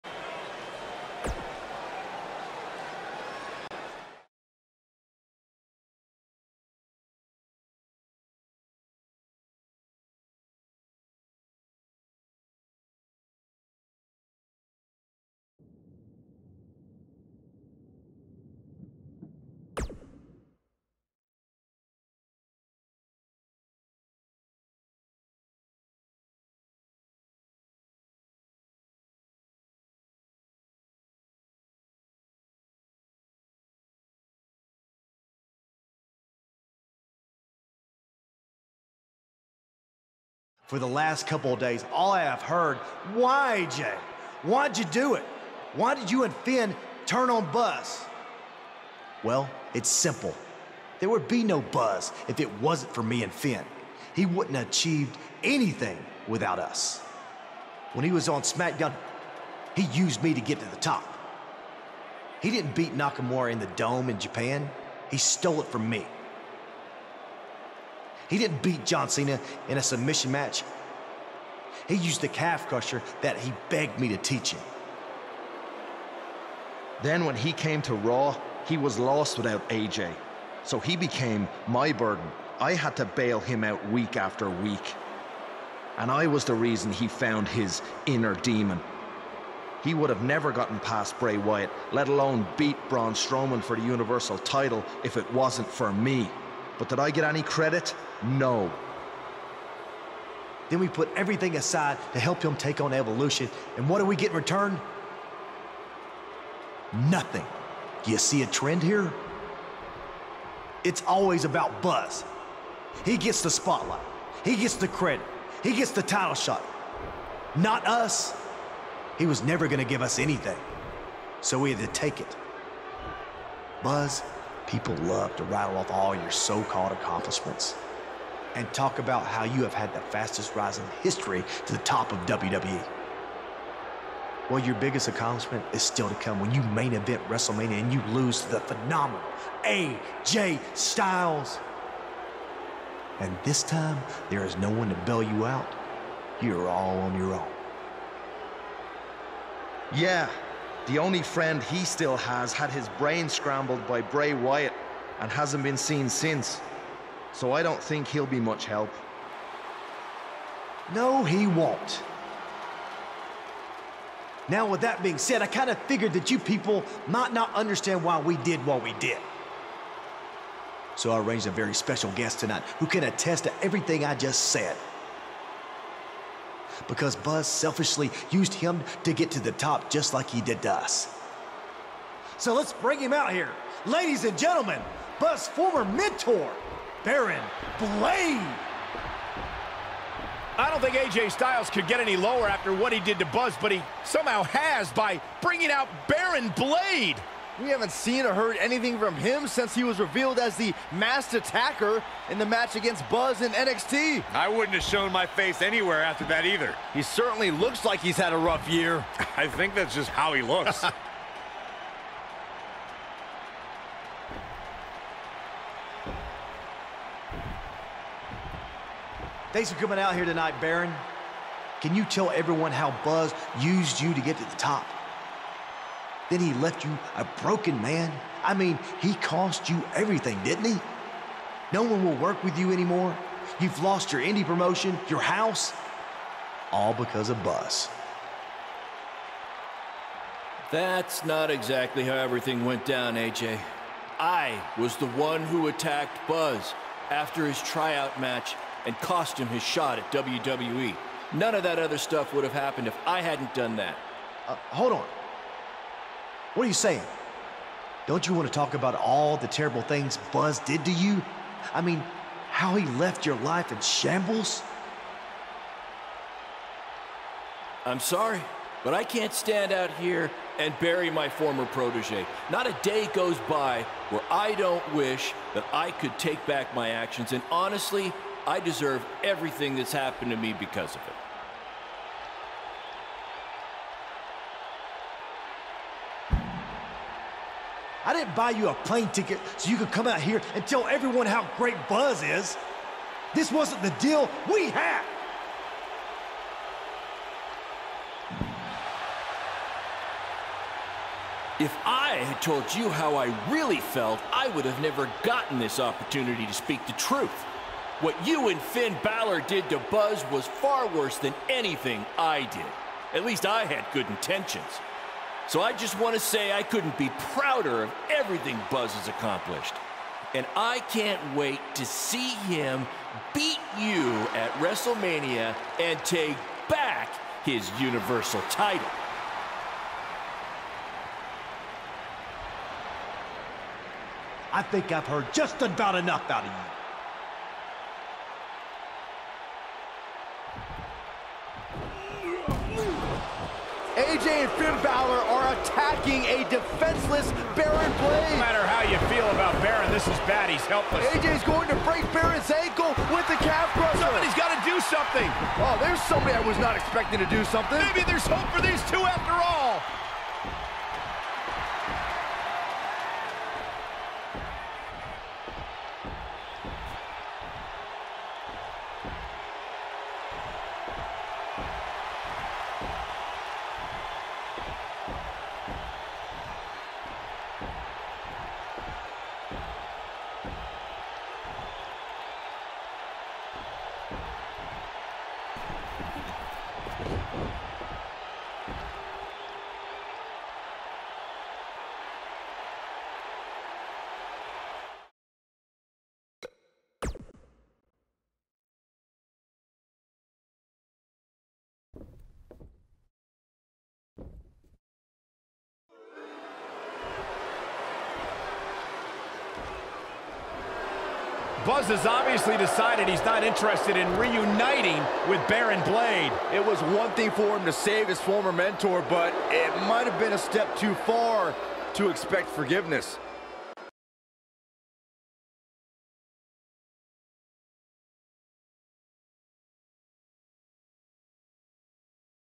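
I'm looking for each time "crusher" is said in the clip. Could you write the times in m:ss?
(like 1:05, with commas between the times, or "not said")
1:12, 5:53.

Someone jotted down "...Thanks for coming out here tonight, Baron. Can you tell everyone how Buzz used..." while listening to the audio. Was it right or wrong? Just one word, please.
right.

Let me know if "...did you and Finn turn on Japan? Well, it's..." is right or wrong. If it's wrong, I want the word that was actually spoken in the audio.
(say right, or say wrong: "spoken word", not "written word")
wrong: "Buzz", not "Japan".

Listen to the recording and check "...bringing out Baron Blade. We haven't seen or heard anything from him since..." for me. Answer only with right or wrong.
right.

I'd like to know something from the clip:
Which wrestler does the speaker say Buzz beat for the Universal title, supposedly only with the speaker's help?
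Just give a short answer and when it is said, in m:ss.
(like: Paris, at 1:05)
Braun Strowman, at 1:32.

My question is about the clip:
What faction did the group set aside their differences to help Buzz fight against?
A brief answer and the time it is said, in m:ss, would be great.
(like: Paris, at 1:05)
Evolution, at 1:42.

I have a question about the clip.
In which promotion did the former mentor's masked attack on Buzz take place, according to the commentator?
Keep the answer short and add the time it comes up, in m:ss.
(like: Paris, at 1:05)
NXT, at 3:23.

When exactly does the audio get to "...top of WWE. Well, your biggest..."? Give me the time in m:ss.
2:11.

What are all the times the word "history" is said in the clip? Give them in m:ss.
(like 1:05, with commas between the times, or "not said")
2:11.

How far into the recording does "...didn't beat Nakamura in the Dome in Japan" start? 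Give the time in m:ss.
1:02.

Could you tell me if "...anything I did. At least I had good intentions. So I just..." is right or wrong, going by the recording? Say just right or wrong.
right.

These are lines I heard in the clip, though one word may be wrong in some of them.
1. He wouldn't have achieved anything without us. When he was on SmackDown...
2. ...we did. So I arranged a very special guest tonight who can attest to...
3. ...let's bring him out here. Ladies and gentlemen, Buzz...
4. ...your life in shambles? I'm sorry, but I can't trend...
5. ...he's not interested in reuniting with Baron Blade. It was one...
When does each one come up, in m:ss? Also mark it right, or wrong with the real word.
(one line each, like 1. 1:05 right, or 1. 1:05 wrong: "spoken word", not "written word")
1. 0:54 right
2. 2:48 right
3. 3:02 right
4. 4:23 wrong: "stand", not "trend"
5. 6:53 right.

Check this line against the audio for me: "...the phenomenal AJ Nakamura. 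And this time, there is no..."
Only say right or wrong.
wrong.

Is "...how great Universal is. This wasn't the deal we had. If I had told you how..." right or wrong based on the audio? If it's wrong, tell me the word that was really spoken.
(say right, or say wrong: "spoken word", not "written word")
wrong: "Buzz", not "Universal".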